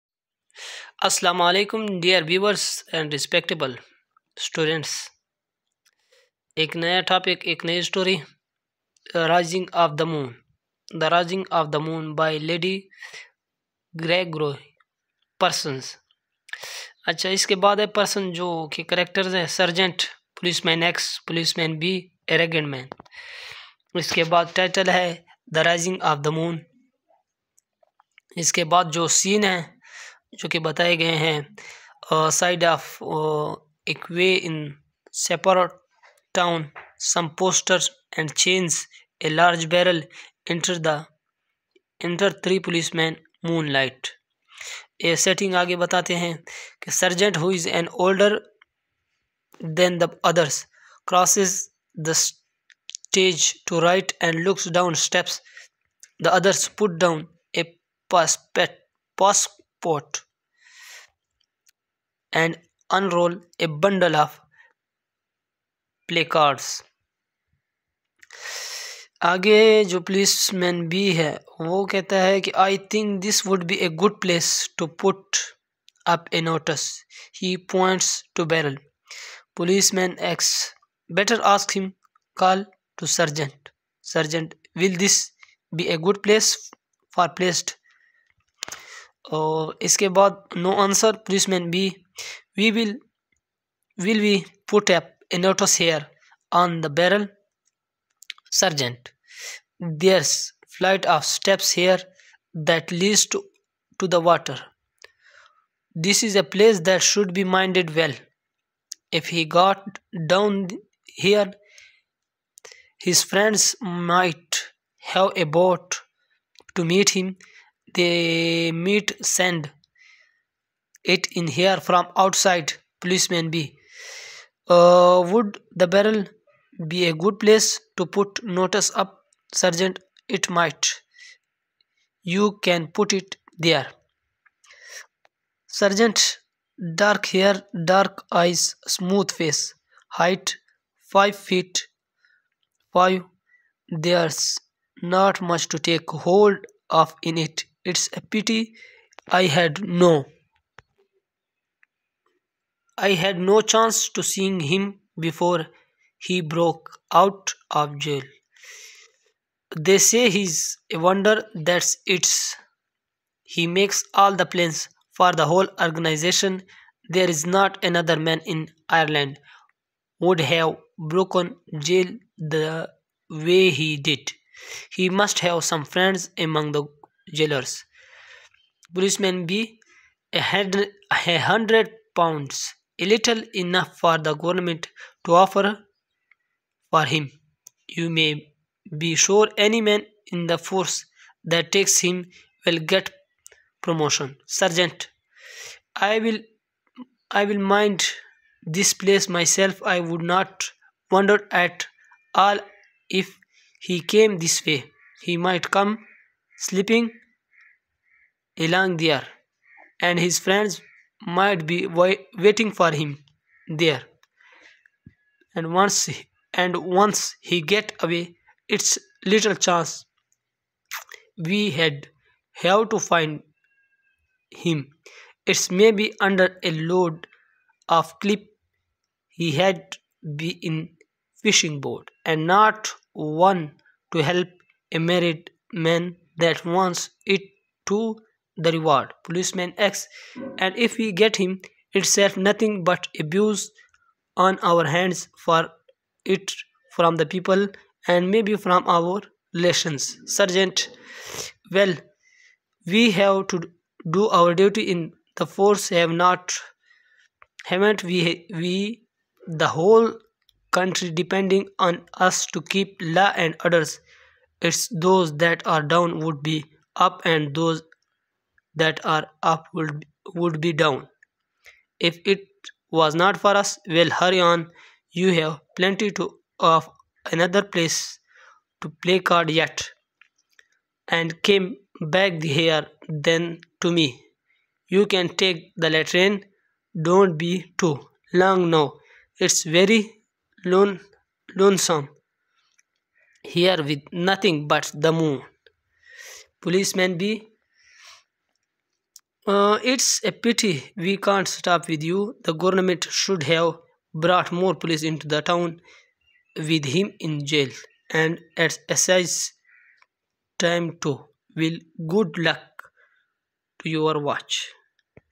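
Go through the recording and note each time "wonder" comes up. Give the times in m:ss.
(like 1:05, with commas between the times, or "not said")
2:40, 3:21.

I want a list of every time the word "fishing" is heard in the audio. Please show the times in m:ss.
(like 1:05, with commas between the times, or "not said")
3:51.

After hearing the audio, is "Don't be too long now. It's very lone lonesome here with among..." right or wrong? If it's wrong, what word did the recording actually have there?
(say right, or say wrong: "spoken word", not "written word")
wrong: "nothing", not "among".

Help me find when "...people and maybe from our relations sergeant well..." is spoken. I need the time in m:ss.
4:07.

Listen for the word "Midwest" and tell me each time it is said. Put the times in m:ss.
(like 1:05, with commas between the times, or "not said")
not said.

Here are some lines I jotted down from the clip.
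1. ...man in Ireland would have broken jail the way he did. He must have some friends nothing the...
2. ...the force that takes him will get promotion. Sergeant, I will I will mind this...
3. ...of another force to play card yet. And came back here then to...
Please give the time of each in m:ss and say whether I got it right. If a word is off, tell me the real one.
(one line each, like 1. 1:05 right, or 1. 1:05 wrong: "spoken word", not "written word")
1. 2:48 wrong: "among", not "nothing"
2. 3:10 right
3. 4:36 wrong: "place", not "force".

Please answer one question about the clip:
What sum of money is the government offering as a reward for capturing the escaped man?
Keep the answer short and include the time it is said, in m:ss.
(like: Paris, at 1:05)
100 pounds, at 3:01.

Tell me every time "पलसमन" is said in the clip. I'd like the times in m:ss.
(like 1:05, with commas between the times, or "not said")
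1:31.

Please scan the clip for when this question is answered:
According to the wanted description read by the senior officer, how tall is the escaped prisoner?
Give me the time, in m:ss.
2:21.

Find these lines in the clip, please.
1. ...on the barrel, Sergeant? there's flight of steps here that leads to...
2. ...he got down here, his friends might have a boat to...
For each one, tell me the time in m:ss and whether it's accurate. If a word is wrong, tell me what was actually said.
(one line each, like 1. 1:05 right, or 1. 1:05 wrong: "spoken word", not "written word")
1. 1:36 right
2. 1:49 right.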